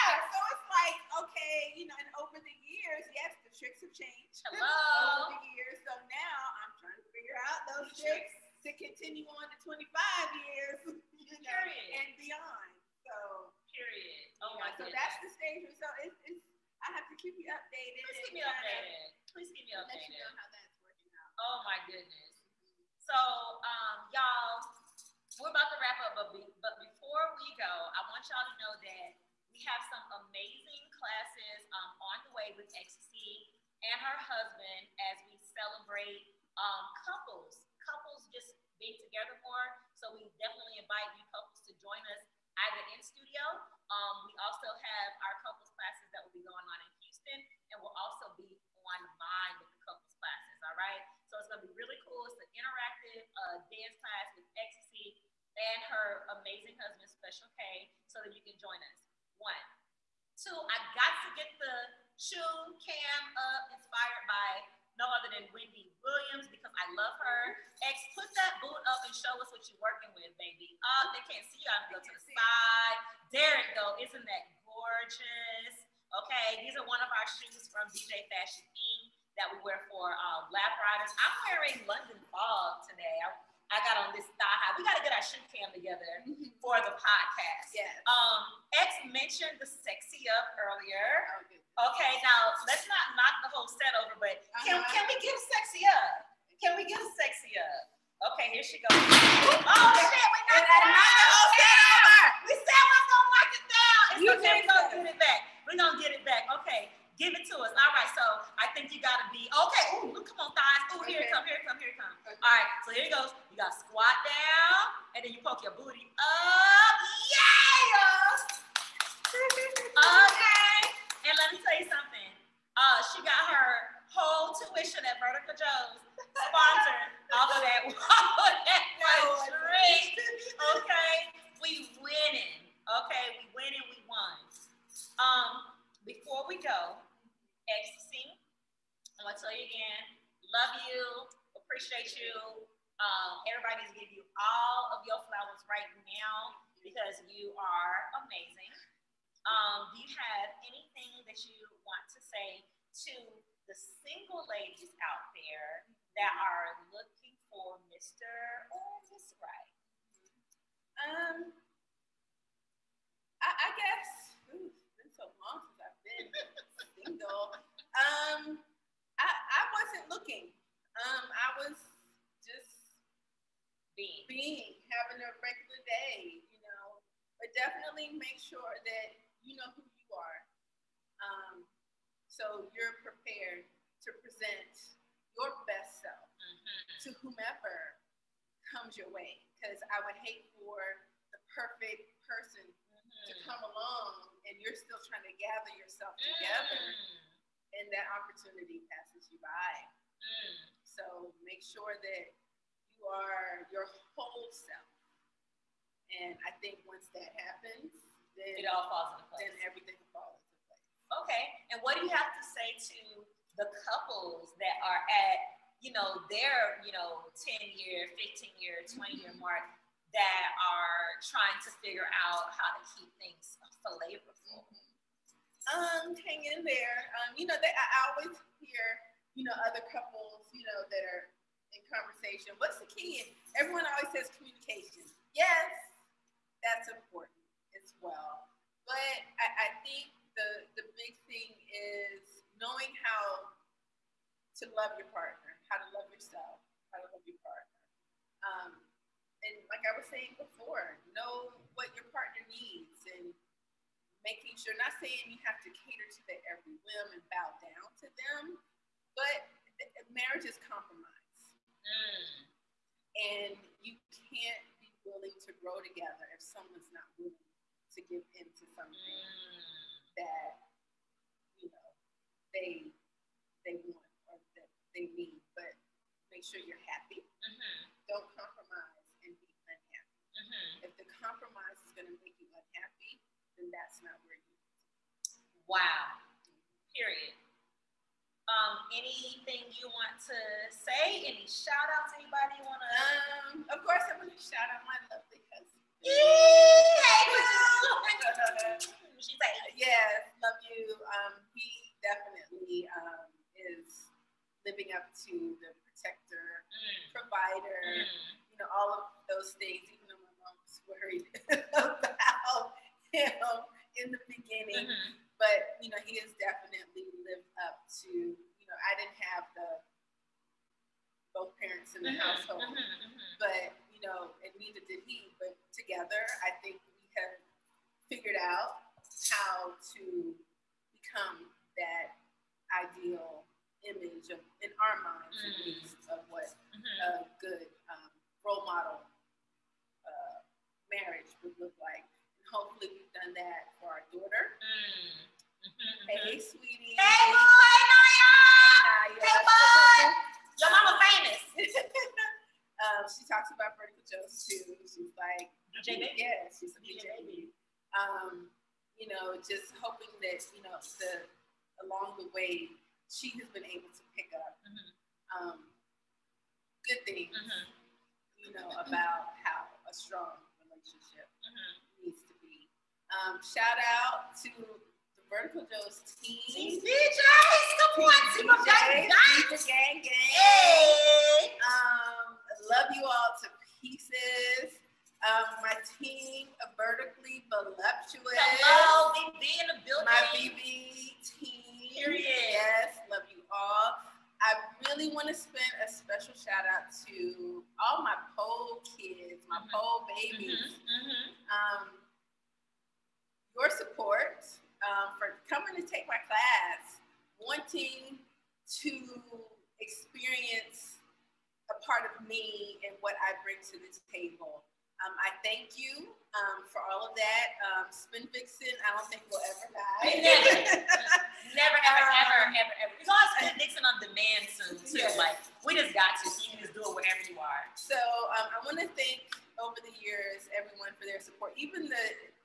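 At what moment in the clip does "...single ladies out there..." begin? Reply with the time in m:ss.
2:33.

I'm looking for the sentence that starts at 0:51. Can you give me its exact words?
So it's gonna be really cool.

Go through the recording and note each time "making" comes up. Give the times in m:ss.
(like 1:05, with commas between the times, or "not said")
4:14.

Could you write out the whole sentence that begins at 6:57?
Um, Spin Vixen, I don't think we'll ever die.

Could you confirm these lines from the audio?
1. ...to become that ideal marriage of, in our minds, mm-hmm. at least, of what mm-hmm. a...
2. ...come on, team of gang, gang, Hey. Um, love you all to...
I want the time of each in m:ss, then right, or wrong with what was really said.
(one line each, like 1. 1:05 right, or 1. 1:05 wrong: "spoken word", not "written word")
1. 5:29 wrong: "image", not "marriage"
2. 6:17 right.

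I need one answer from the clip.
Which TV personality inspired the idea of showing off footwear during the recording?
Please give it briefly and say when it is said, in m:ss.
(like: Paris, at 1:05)
Wendy Williams, at 1:05.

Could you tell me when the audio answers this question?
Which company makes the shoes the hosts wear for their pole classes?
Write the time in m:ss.
1:17.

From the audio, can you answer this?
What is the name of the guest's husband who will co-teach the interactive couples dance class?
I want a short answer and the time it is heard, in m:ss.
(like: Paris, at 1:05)
Special K, at 0:57.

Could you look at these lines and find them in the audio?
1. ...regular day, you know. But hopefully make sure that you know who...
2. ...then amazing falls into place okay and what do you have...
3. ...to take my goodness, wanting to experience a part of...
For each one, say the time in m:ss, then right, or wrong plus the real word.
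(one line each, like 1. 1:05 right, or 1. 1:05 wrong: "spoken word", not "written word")
1. 2:55 wrong: "definitely", not "hopefully"
2. 3:29 wrong: "everything", not "amazing"
3. 6:45 wrong: "class", not "goodness".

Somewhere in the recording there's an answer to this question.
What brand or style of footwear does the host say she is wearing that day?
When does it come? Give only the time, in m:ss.
1:21.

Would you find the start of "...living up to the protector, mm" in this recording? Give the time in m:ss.
5:04.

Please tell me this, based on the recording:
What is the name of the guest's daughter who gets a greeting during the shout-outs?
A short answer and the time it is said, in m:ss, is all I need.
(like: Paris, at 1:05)
Naya, at 5:47.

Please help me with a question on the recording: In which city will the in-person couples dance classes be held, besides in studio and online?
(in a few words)
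Houston.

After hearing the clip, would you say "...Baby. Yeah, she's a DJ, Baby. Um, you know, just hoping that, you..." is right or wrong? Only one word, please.
right.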